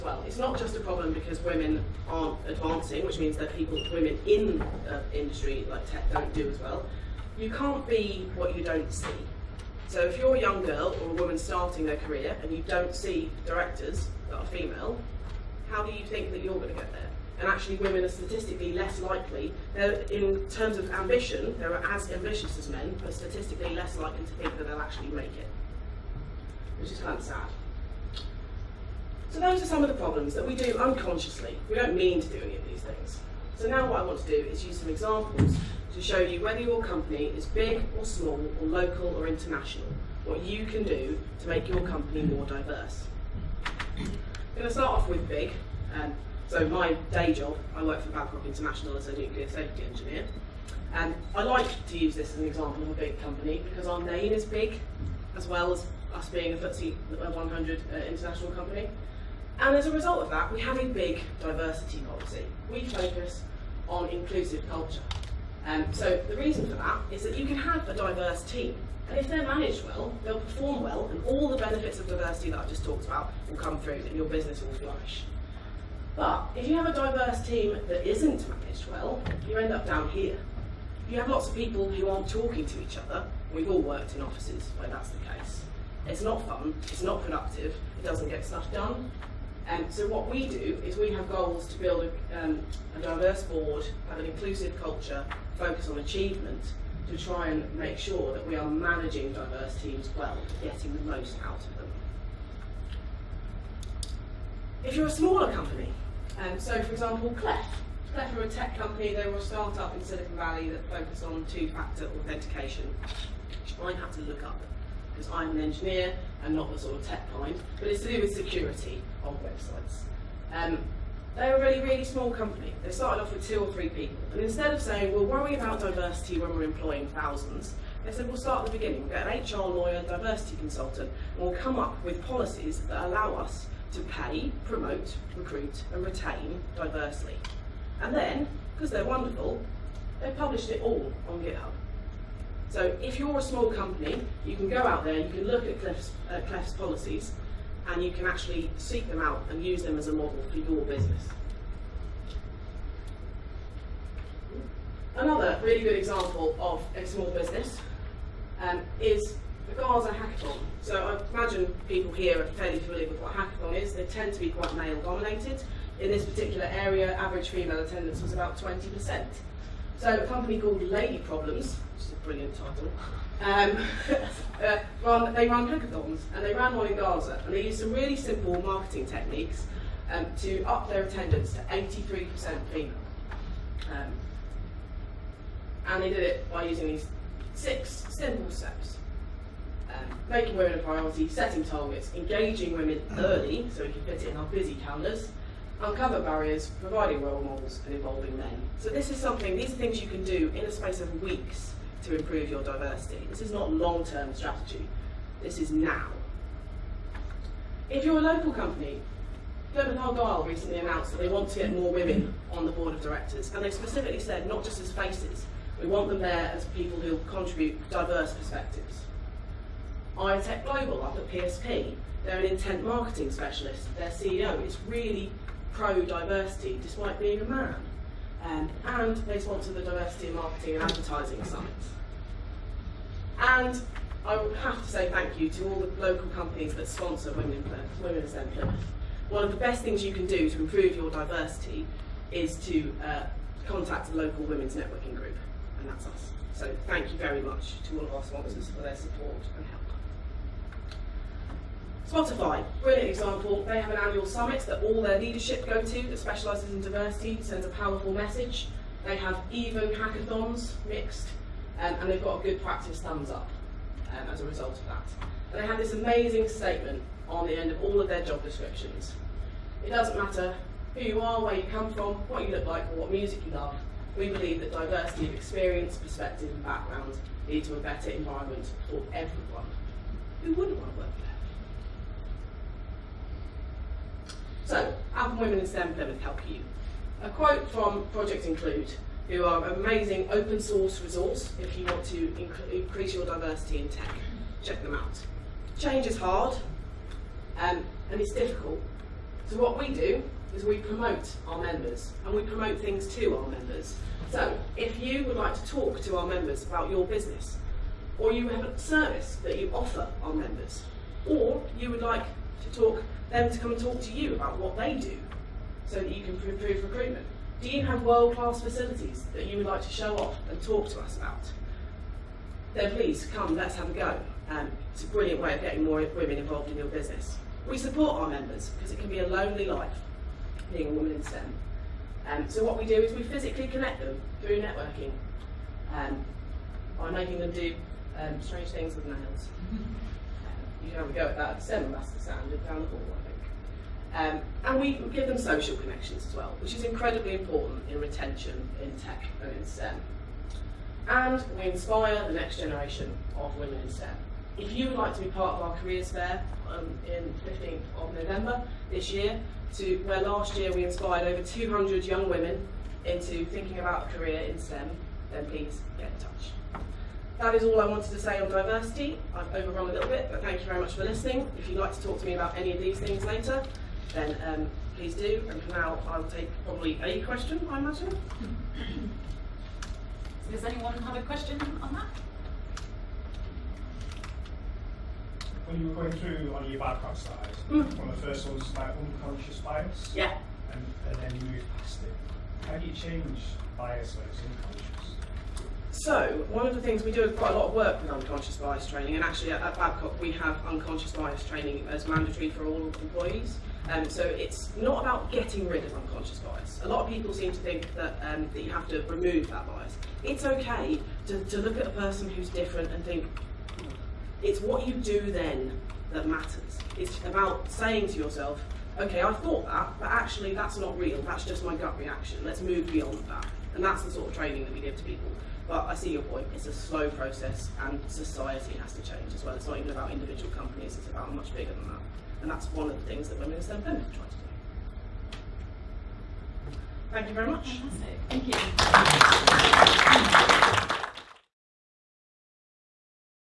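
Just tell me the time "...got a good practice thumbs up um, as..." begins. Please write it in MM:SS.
04:22.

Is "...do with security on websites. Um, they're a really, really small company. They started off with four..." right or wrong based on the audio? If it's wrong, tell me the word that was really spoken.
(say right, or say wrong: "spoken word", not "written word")
wrong: "two", not "four".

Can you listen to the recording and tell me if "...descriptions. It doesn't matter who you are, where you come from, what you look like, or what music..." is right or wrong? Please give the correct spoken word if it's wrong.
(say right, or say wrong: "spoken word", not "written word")
right.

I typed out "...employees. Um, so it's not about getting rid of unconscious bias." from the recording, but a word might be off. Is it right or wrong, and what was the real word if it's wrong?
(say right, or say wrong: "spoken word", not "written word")
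right.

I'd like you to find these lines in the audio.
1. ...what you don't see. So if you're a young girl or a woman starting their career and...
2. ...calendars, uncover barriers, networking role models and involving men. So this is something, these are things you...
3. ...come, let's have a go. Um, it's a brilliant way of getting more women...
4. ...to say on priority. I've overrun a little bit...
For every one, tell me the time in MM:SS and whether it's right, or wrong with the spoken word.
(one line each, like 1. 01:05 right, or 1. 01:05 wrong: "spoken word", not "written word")
1. 00:08 right
2. 03:14 wrong: "providing", not "networking"
3. 05:23 right
4. 06:08 wrong: "diversity", not "priority".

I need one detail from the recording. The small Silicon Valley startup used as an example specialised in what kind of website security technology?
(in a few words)
two-factor authentication.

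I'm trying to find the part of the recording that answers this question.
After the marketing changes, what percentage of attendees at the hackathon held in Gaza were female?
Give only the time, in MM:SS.
03:01.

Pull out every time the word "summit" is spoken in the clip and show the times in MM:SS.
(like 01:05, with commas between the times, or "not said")
03:51, 04:14.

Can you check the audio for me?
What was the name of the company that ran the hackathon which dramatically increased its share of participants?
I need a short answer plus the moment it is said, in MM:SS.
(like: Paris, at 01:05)
Lady Problems, at 02:50.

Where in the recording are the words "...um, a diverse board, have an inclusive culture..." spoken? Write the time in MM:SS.
01:32.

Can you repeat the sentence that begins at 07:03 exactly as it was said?
And that's the sort of training that we give to people.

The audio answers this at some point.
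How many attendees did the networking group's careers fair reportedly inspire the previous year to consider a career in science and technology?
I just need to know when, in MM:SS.
06:01.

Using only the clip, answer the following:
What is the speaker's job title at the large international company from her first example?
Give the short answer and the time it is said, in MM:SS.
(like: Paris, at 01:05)
nuclear safety engineer, at 00:49.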